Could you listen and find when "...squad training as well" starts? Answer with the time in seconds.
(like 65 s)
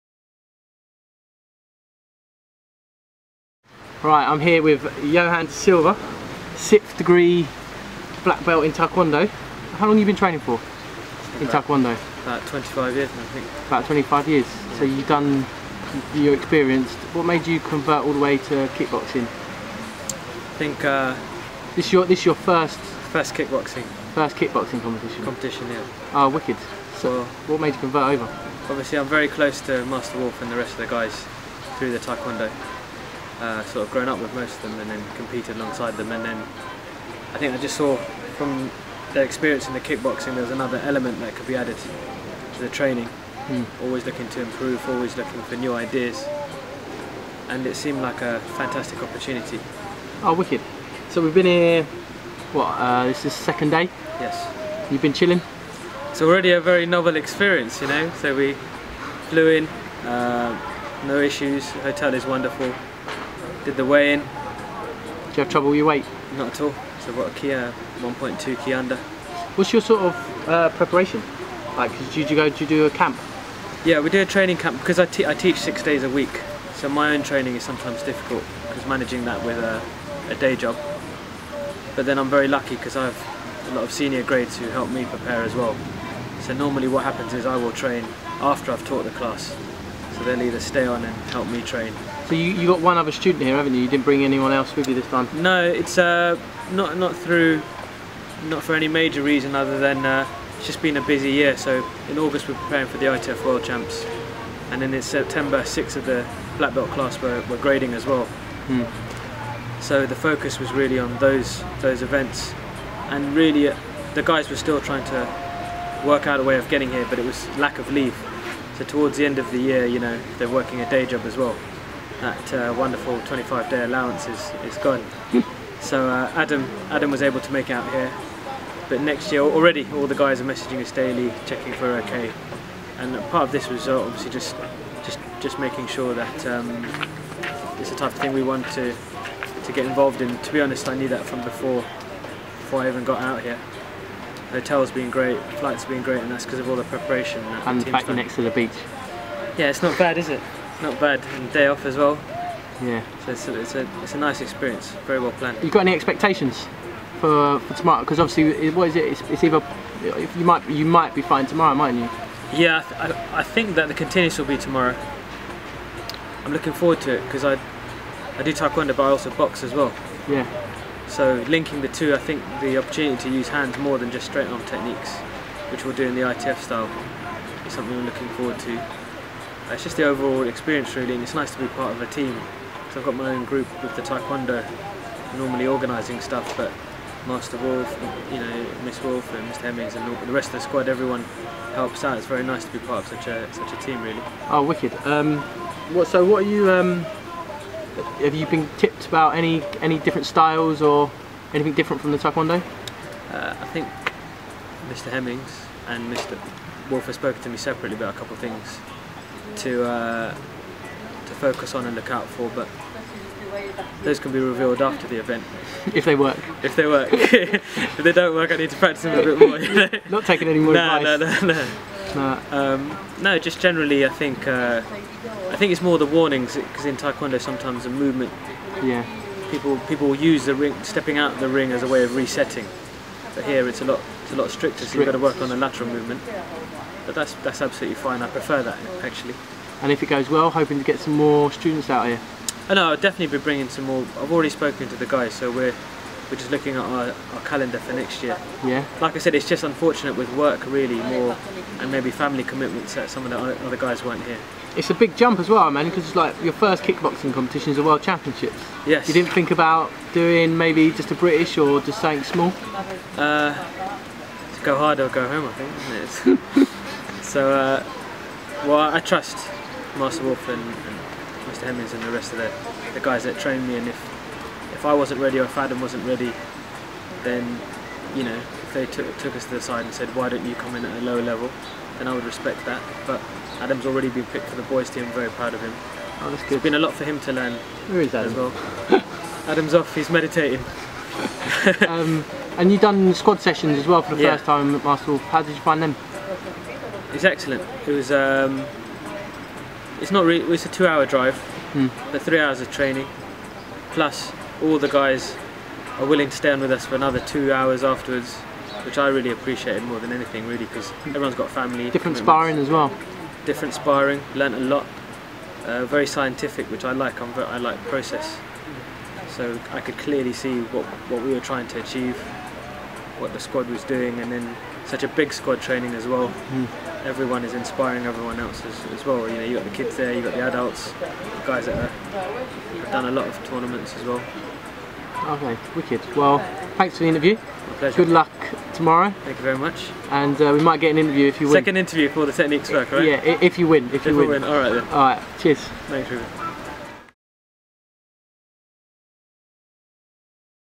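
325 s.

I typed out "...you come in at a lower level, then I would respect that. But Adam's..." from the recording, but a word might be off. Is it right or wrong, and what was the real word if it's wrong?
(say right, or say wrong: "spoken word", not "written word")
right.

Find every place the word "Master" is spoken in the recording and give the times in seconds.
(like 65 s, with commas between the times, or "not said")
29 s, 187 s, 269 s.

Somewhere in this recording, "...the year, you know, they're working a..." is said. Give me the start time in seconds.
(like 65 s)
119 s.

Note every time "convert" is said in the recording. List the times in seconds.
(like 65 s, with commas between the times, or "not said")
17 s, 27 s.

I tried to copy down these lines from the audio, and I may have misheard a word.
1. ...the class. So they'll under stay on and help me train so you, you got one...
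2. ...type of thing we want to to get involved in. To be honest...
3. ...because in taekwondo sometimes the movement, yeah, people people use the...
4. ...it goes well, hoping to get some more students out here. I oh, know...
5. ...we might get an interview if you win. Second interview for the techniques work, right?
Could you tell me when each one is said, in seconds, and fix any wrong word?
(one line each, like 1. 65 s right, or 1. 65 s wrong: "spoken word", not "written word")
1. 89 s wrong: "either", not "under"
2. 137 s right
3. 226 s right
4. 240 s right
5. 340 s right.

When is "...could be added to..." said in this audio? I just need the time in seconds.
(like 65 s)
41 s.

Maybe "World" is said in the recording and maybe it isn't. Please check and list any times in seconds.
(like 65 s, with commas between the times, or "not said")
103 s, 257 s.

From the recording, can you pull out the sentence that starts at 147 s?
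And, and the fact you're next to the beach.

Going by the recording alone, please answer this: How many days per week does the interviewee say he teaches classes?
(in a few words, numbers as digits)
6.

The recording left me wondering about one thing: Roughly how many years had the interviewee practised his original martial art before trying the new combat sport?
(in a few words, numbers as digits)
25 years.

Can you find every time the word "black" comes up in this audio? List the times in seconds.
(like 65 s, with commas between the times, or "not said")
8 s, 106 s.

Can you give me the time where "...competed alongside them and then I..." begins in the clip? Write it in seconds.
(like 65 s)
35 s.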